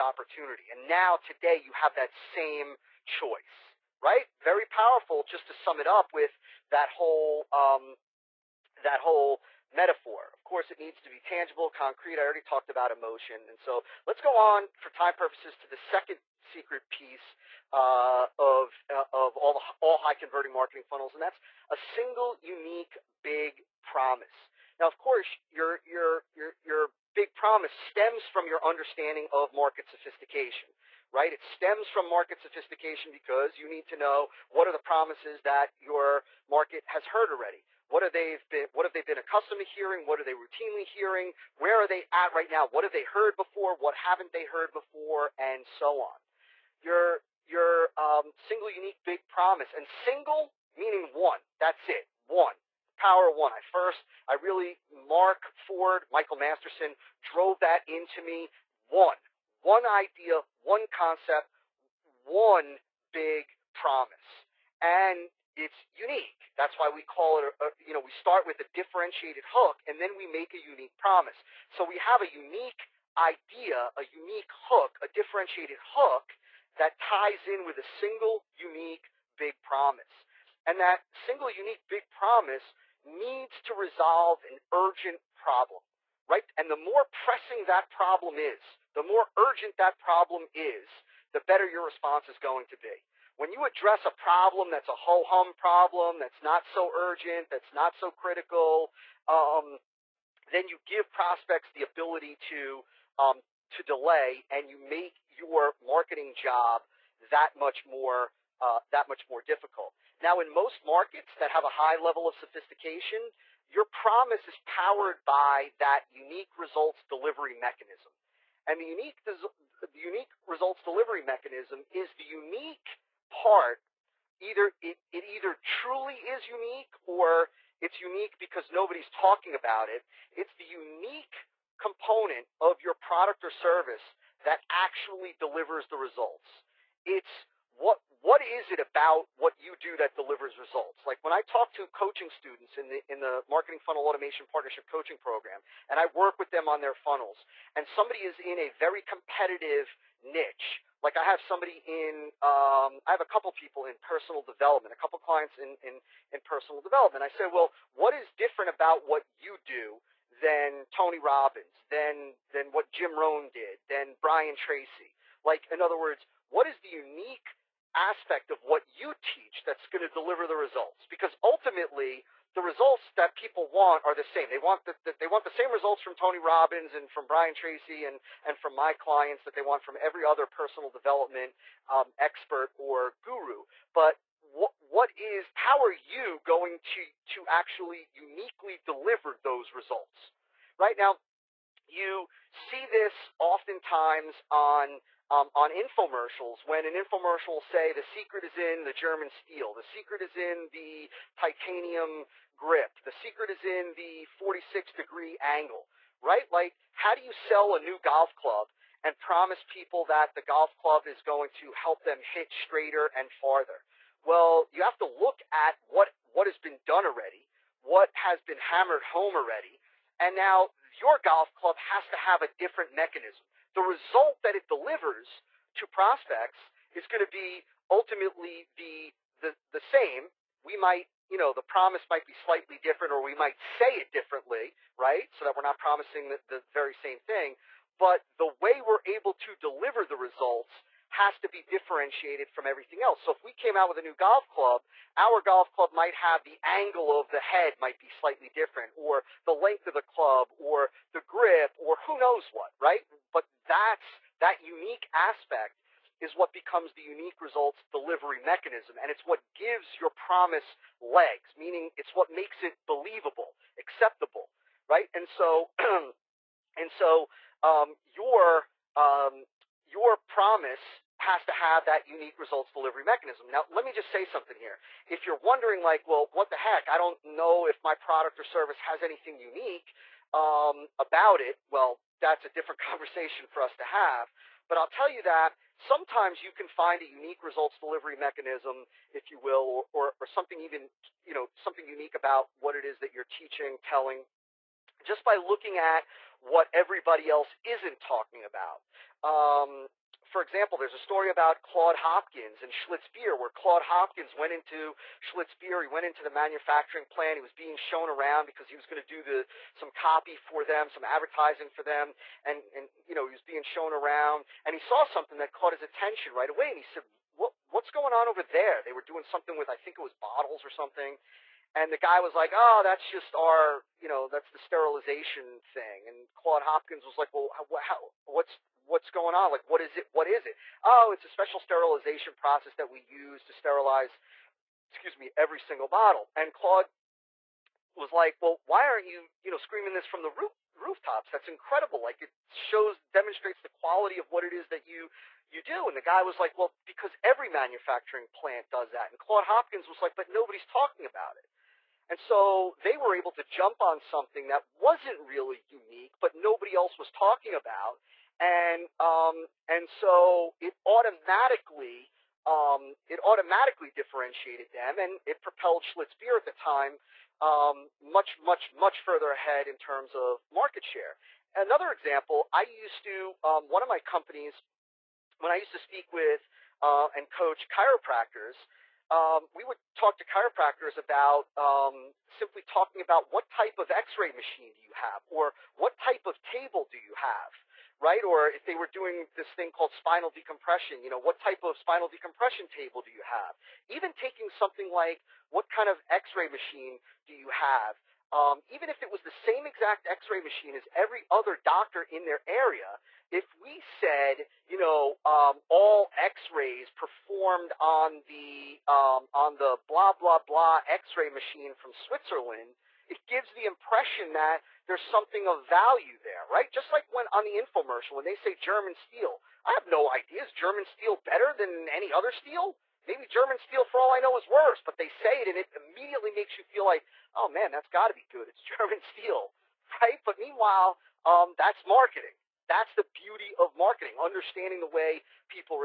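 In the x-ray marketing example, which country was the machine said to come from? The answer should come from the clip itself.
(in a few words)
Switzerland.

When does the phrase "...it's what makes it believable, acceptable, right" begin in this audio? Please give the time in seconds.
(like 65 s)
261 s.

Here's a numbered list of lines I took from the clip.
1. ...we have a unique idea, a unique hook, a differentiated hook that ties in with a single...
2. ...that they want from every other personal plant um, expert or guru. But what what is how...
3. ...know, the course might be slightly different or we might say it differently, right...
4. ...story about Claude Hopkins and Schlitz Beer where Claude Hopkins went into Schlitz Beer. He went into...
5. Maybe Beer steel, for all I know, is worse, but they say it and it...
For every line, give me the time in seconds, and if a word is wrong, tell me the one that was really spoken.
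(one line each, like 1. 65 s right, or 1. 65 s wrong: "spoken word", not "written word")
1. 71 s right
2. 179 s wrong: "development", not "plant"
3. 231 s wrong: "promise", not "course"
4. 300 s right
5. 423 s wrong: "German", not "Beer".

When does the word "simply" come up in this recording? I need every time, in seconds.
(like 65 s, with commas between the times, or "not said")
382 s.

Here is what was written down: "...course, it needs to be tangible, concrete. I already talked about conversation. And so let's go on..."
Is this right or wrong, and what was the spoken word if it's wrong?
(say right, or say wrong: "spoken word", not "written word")
wrong: "emotion", not "conversation".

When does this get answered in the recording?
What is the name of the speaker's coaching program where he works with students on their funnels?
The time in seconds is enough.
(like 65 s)
143 s.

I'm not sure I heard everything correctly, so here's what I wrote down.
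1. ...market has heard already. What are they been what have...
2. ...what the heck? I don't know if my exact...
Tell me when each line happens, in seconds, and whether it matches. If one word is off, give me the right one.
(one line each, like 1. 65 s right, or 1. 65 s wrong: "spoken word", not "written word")
1. 36 s right
2. 276 s wrong: "product", not "exact".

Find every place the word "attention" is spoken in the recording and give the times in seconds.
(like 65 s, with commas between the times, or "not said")
315 s.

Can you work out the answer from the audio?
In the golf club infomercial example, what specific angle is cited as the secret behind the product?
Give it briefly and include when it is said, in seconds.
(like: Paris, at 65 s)
46 degree angle, at 204 s.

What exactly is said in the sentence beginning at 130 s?
It's the unique component of your product or service that actually delivers the results.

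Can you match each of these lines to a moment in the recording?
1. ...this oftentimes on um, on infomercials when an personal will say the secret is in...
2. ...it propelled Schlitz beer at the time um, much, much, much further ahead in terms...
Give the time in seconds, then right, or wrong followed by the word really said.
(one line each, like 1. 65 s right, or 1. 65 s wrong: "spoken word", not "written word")
1. 192 s wrong: "infomercial", not "personal"
2. 365 s right.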